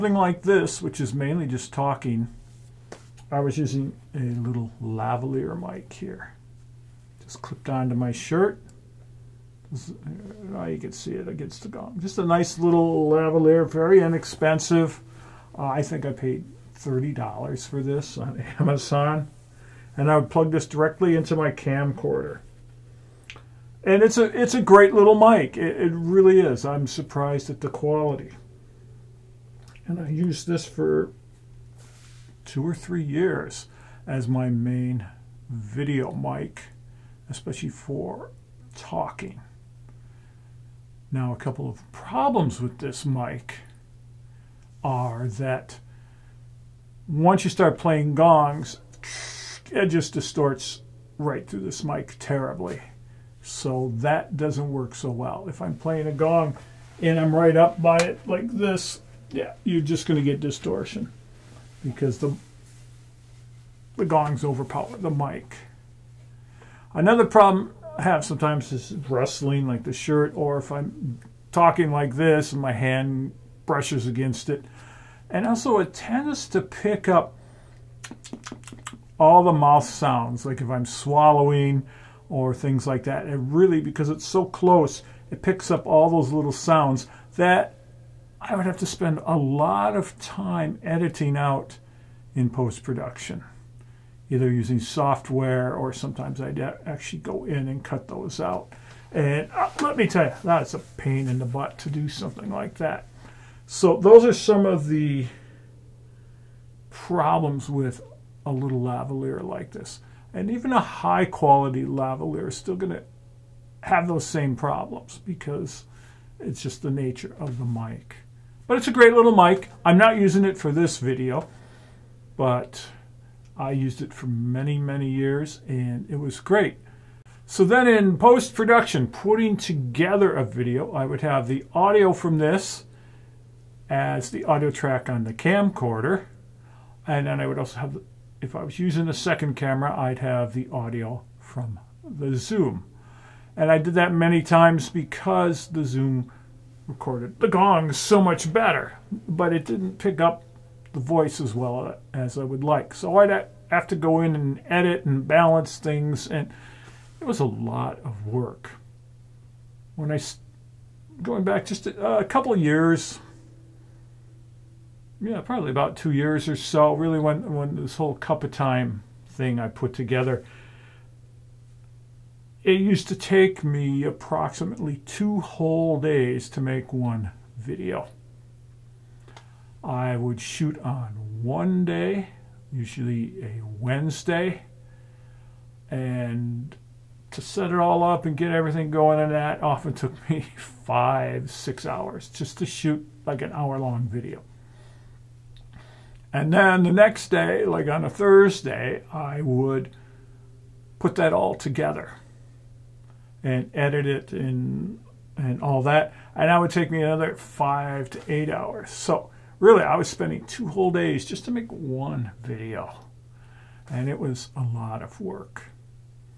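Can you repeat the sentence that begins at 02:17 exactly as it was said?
And then I would also have, if I was using a second camera, I'd have the audio from the Zoom.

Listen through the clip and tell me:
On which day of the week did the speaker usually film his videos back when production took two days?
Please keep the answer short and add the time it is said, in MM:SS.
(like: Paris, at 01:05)
Wednesday, at 03:03.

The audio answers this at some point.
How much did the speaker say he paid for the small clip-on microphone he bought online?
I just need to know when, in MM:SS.
00:16.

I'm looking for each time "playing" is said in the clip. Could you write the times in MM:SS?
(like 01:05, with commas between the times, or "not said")
00:47, 00:55.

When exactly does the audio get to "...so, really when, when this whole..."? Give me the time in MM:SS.
02:46.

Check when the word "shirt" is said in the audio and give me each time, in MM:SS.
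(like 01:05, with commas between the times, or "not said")
00:08, 01:09.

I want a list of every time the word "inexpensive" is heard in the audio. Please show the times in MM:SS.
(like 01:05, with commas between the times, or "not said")
00:14.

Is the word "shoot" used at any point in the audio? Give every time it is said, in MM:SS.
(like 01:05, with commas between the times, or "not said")
03:00, 03:12.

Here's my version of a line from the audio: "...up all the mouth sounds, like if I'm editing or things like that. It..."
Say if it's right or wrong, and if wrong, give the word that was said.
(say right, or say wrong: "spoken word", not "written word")
wrong: "swallowing", not "editing".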